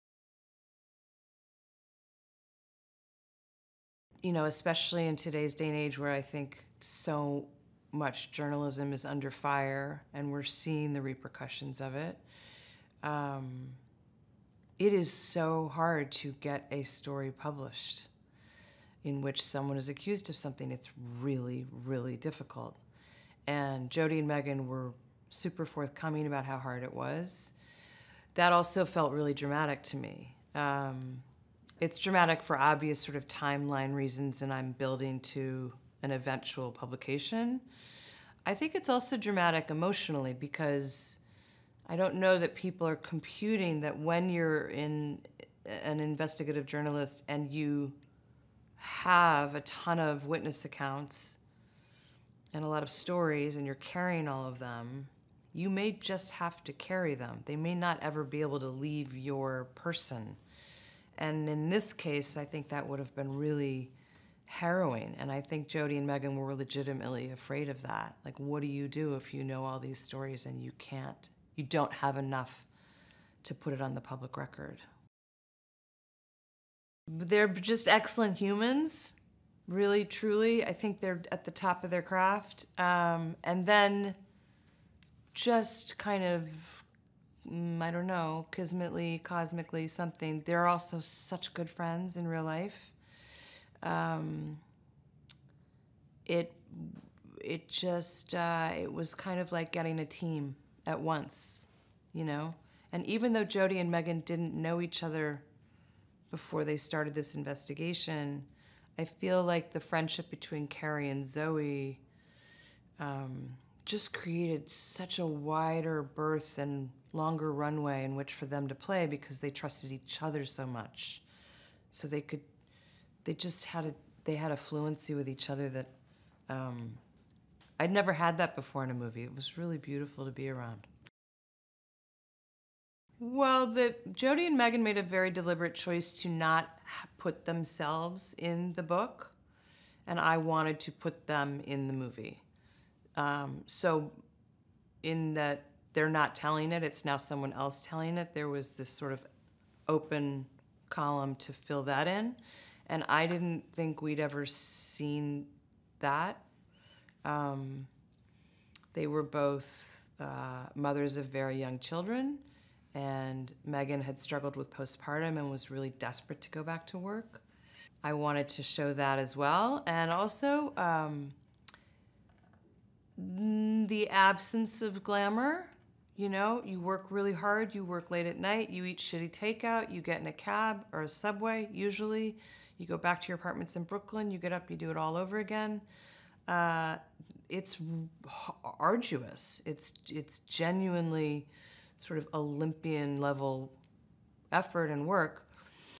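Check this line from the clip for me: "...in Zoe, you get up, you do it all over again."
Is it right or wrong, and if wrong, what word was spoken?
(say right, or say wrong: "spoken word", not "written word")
wrong: "Brooklyn", not "Zoe".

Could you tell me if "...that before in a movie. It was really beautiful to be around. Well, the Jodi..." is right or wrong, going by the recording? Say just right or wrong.
right.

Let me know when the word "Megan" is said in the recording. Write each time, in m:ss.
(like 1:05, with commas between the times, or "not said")
0:24, 1:06, 1:43, 2:14, 2:43.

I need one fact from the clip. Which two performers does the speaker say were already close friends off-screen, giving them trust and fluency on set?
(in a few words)
Carey and Zoe.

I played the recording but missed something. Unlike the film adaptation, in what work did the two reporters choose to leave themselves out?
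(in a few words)
the book.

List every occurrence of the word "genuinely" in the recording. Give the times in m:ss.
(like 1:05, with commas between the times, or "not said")
3:10.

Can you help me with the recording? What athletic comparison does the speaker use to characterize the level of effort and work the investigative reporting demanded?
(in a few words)
Olympian.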